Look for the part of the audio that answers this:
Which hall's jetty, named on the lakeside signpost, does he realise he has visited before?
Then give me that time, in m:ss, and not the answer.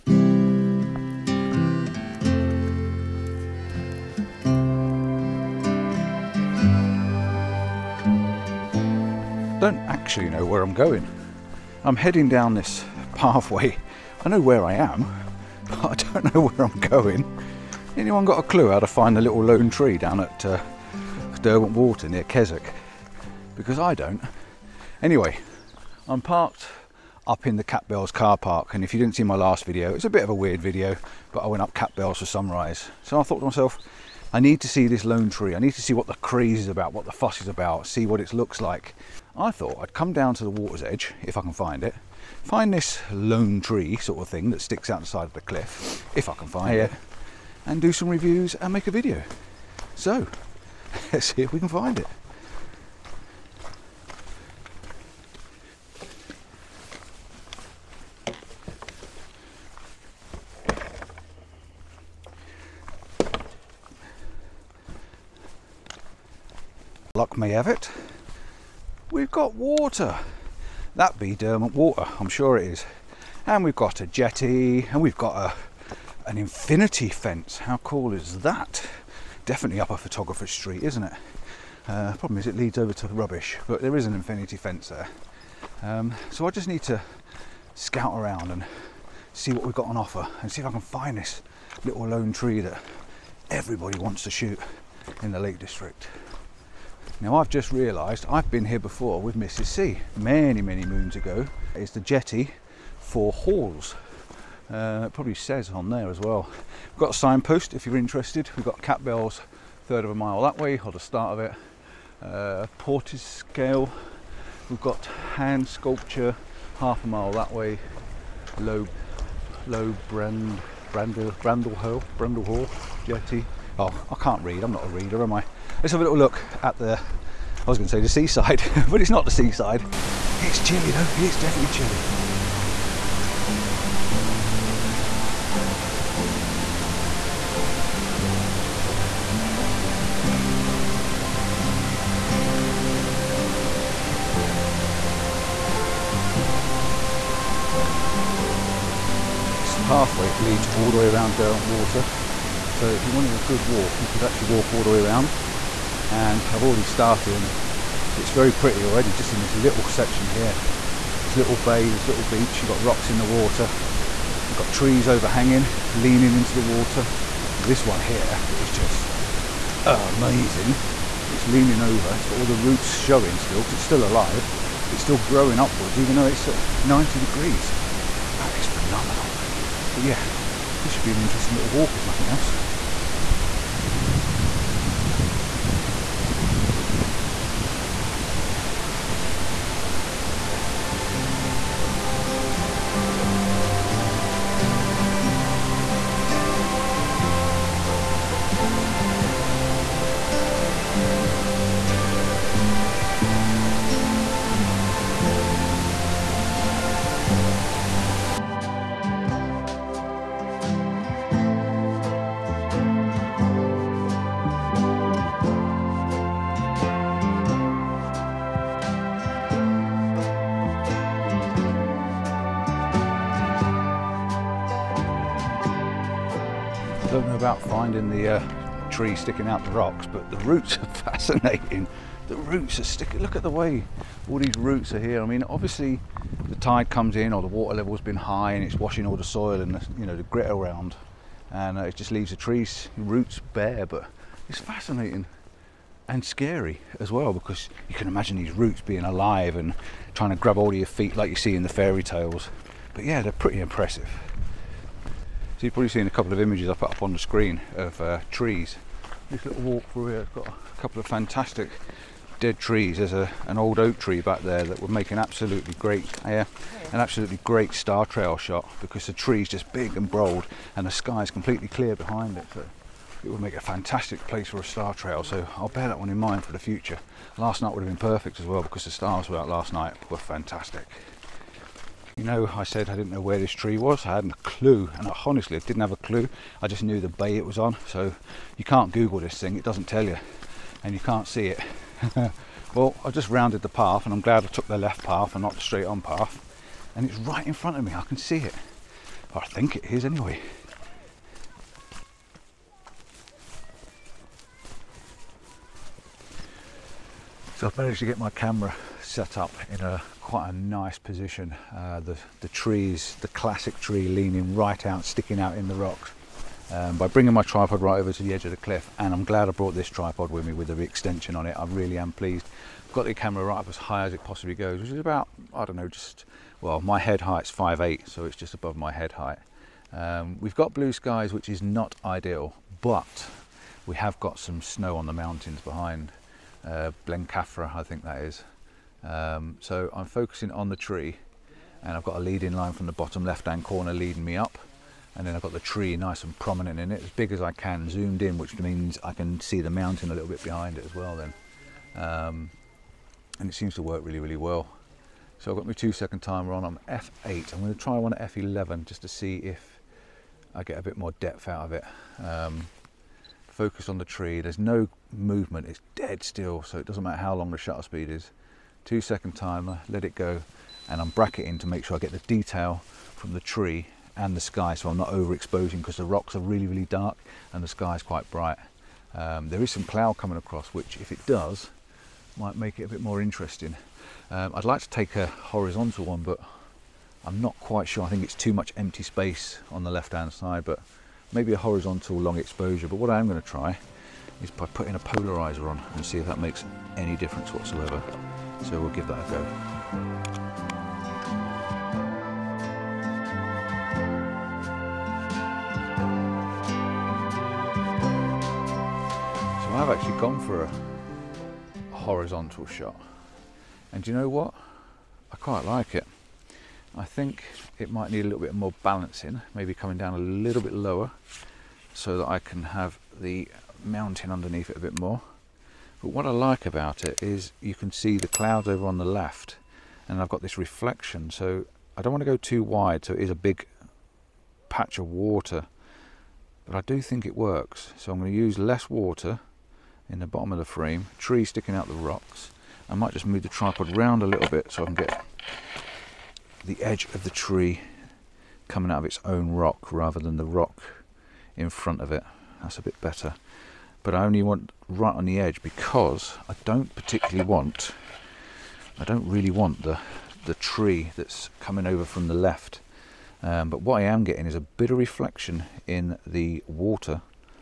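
2:02.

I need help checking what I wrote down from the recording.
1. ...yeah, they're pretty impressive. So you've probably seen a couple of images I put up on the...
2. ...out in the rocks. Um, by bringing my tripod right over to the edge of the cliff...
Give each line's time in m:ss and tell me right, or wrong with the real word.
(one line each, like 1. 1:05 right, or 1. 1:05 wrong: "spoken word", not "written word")
1. 4:13 right
2. 5:15 right.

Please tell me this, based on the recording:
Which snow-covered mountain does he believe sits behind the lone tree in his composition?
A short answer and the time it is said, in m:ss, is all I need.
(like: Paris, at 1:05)
Blencathra, at 5:37.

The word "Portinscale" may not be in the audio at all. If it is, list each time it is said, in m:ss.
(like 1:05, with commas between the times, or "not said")
1:52.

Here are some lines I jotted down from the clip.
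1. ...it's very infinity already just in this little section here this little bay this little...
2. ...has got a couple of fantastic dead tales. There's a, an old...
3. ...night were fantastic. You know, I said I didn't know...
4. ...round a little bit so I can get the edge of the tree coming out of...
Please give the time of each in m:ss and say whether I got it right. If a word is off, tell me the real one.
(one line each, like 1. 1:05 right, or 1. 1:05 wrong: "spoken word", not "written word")
1. 2:38 wrong: "pretty", not "infinity"
2. 4:20 wrong: "trees", not "tales"
3. 4:39 right
4. 7:23 right.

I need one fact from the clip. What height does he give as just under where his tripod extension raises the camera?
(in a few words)
5'8.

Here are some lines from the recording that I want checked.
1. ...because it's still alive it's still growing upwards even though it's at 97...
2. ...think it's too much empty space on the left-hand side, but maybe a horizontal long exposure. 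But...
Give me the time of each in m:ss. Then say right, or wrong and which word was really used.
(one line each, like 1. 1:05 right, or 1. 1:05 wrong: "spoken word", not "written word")
1. 2:53 wrong: "90", not "97"
2. 6:28 right.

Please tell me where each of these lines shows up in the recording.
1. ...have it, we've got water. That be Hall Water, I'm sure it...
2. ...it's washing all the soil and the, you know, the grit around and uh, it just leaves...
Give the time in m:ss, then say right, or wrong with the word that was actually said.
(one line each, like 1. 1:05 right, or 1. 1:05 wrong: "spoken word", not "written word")
1. 1:07 wrong: "Derwent", not "Hall"
2. 3:58 right.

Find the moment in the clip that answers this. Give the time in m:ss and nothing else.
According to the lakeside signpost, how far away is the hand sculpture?
1:56.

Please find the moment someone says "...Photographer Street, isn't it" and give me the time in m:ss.
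1:19.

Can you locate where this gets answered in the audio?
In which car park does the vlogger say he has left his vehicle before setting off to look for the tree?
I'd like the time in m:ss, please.
0:27.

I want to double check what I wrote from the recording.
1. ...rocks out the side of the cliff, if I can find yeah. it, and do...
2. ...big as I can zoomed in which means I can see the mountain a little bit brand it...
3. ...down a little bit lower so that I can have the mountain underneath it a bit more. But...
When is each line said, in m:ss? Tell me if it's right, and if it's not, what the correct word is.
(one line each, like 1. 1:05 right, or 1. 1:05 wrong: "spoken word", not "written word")
1. 0:44 wrong: "sticks", not "rocks"
2. 5:47 wrong: "behind", not "brand"
3. 6:59 right.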